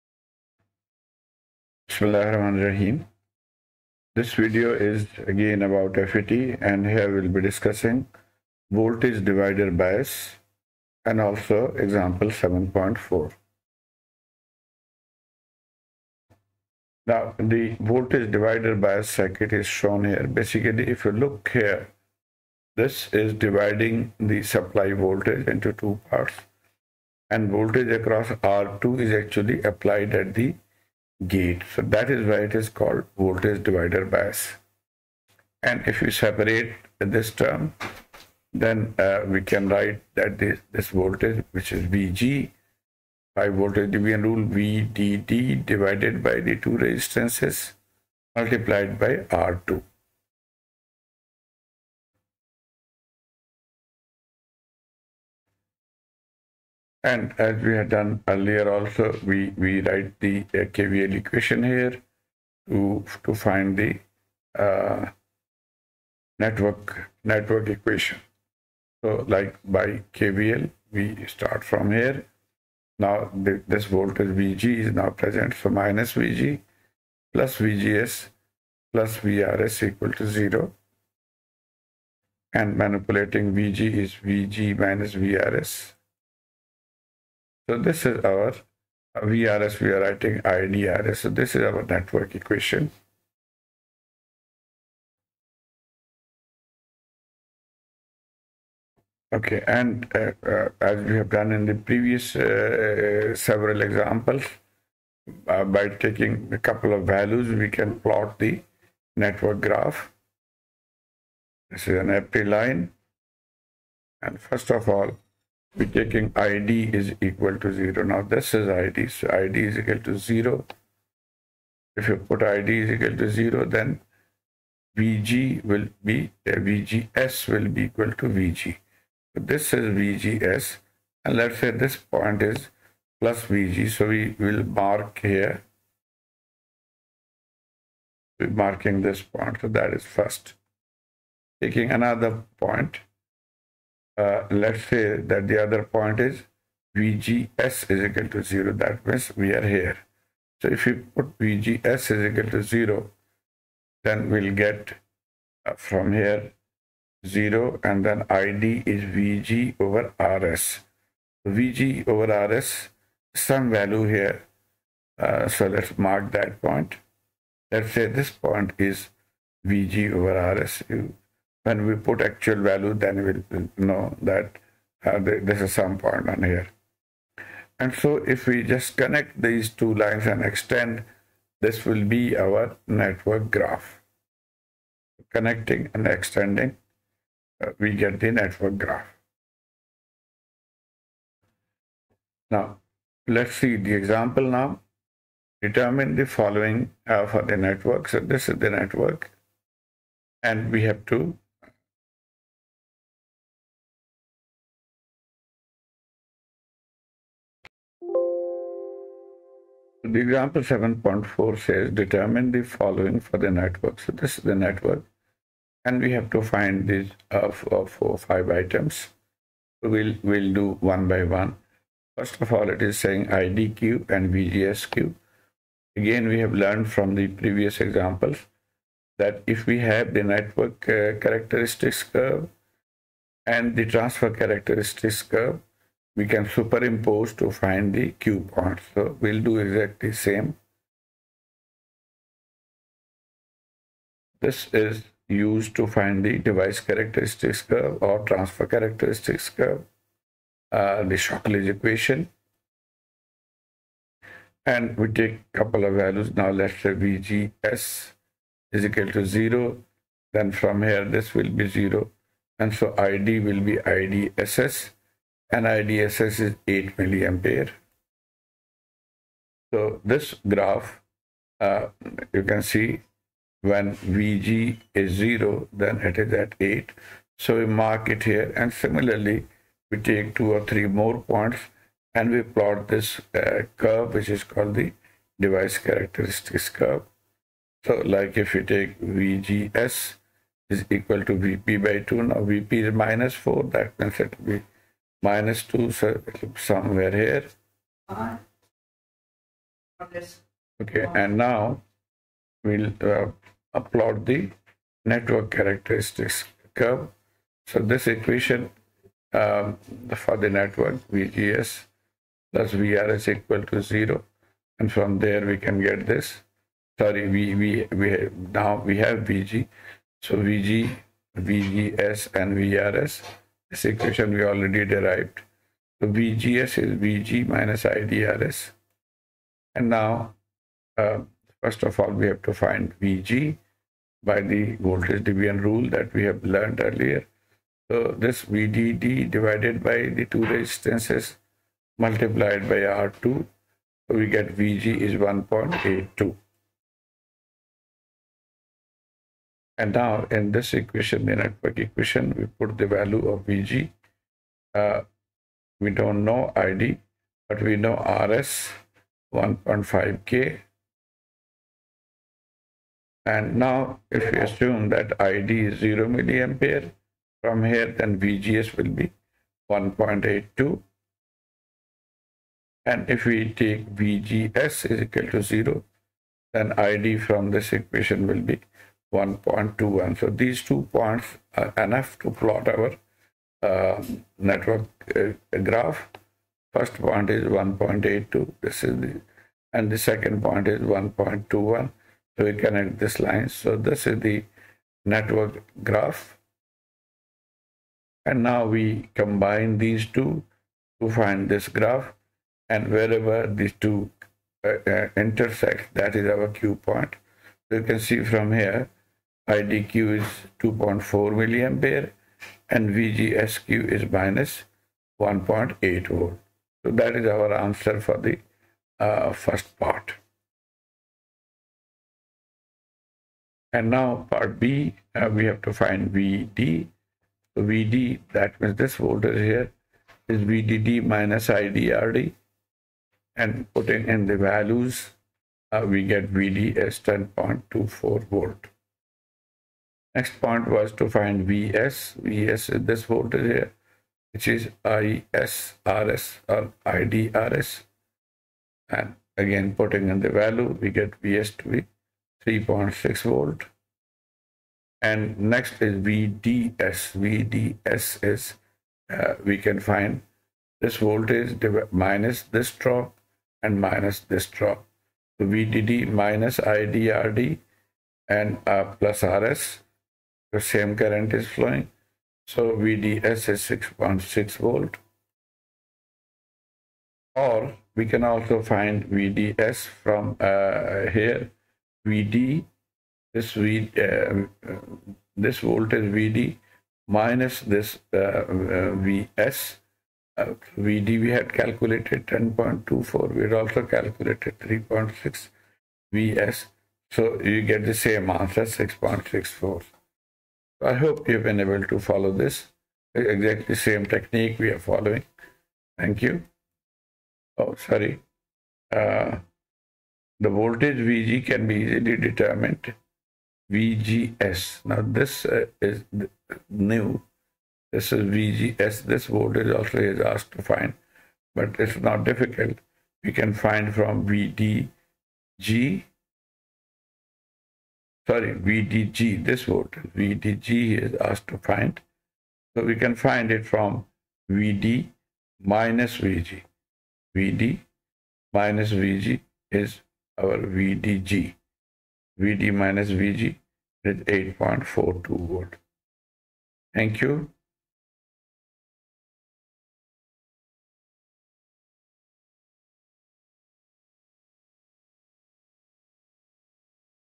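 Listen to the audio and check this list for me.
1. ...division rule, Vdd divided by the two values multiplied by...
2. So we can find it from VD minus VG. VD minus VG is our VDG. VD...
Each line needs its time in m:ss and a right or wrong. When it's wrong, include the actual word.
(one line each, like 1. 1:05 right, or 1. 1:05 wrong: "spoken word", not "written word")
1. 0:43 wrong: "resistances", not "values"
2. 8:52 right.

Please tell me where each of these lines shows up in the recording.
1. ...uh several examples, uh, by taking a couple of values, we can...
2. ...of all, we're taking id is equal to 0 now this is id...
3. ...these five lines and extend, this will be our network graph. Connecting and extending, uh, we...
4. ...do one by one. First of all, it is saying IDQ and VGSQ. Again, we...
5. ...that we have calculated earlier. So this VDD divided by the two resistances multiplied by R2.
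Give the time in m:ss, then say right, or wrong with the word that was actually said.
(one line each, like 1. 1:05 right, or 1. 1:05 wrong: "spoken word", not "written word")
1. 1:43 right
2. 1:54 right
3. 2:59 wrong: "two", not "five"
4. 3:40 right
5. 5:35 wrong: "learned", not "calculated".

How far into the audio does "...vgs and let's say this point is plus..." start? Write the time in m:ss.
2:09.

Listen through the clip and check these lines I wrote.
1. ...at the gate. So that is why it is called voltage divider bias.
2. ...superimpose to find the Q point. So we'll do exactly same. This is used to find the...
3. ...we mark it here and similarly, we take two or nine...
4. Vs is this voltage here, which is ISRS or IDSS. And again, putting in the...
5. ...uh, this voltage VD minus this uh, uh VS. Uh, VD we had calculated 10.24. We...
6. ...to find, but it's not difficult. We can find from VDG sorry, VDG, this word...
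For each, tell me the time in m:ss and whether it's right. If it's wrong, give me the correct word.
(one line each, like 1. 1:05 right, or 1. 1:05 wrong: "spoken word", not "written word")
1. 0:30 right
2. 3:56 right
3. 4:37 wrong: "three", not "nine"
4. 7:22 wrong: "IDRS", not "IDSS"
5. 8:03 right
6. 8:40 right.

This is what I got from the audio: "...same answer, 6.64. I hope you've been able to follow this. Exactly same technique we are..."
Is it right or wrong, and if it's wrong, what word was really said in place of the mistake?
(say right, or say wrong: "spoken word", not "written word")
right.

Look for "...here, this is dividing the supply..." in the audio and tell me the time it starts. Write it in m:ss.
0:21.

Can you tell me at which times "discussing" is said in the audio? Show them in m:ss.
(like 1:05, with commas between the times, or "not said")
0:07.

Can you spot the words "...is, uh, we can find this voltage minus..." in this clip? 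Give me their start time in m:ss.
7:38.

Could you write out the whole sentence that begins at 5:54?
Uh, we don't know ID, but we know RS 1.5K.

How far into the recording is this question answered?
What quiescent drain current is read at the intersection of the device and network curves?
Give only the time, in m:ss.
6:50.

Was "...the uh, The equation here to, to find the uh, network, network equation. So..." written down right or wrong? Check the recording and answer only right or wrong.
wrong.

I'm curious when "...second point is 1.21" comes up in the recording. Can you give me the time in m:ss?
6:29.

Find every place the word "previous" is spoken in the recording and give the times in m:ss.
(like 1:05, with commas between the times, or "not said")
1:41, 3:47.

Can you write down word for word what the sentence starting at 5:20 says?
So VG, VGS and VRS this equation we already derived.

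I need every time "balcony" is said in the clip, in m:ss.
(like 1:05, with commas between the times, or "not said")
not said.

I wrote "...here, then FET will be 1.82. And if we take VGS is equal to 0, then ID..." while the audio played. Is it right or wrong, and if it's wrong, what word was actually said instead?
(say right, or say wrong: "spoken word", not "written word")
wrong: "VGS", not "FET".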